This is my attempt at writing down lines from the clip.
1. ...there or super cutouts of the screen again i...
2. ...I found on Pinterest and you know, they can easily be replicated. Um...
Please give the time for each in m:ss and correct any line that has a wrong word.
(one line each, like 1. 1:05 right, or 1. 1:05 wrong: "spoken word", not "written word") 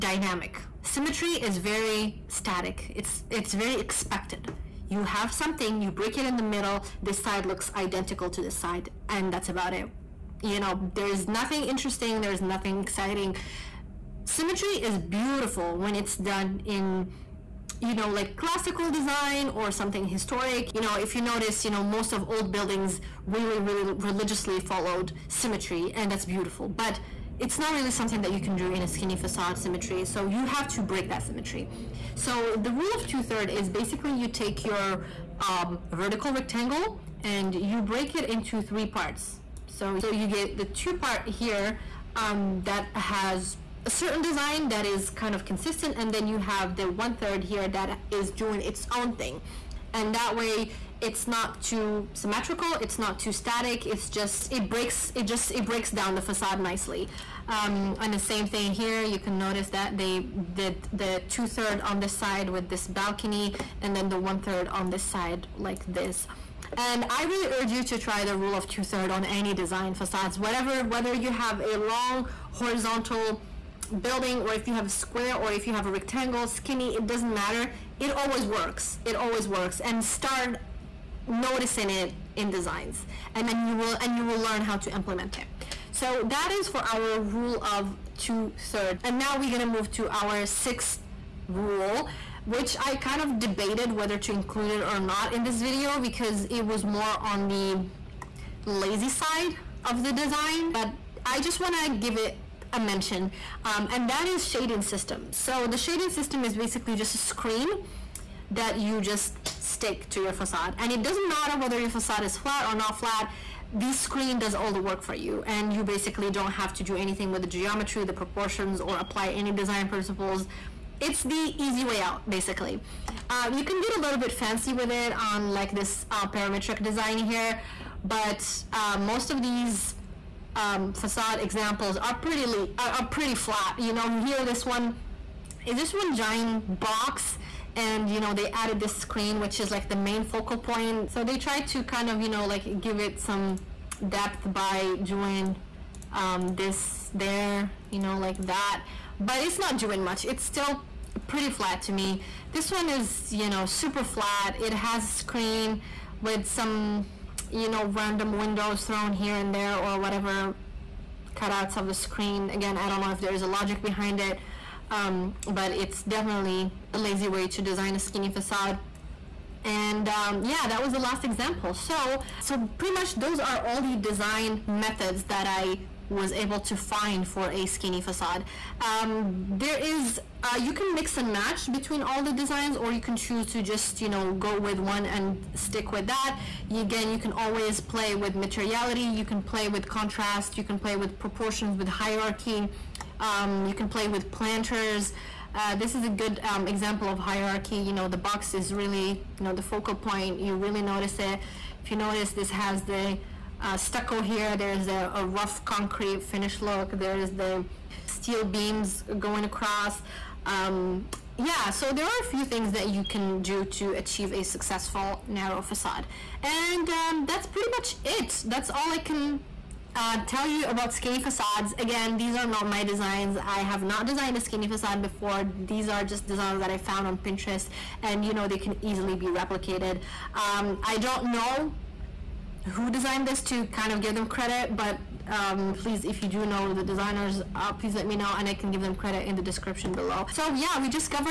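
1. 2:39 wrong: "whatever", not "super"
2. 3:46 right.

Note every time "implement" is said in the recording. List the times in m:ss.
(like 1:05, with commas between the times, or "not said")
1:24.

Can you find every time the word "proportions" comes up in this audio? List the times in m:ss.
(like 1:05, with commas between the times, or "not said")
1:58, 3:11.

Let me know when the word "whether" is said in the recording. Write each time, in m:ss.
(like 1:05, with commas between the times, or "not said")
1:10, 1:33, 1:51.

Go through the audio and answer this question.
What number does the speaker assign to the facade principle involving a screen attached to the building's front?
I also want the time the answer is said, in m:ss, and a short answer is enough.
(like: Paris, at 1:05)
6th, at 1:30.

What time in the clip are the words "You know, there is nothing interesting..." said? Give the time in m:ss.
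0:10.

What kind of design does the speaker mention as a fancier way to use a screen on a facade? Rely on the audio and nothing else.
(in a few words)
Parametric design.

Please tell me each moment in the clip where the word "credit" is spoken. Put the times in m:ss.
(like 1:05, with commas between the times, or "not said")
3:54, 3:58.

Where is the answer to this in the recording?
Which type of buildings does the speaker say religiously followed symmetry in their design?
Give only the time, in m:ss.
0:22.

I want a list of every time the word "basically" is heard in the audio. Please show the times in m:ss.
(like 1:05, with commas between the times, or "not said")
0:33, 1:46, 1:55, 2:02.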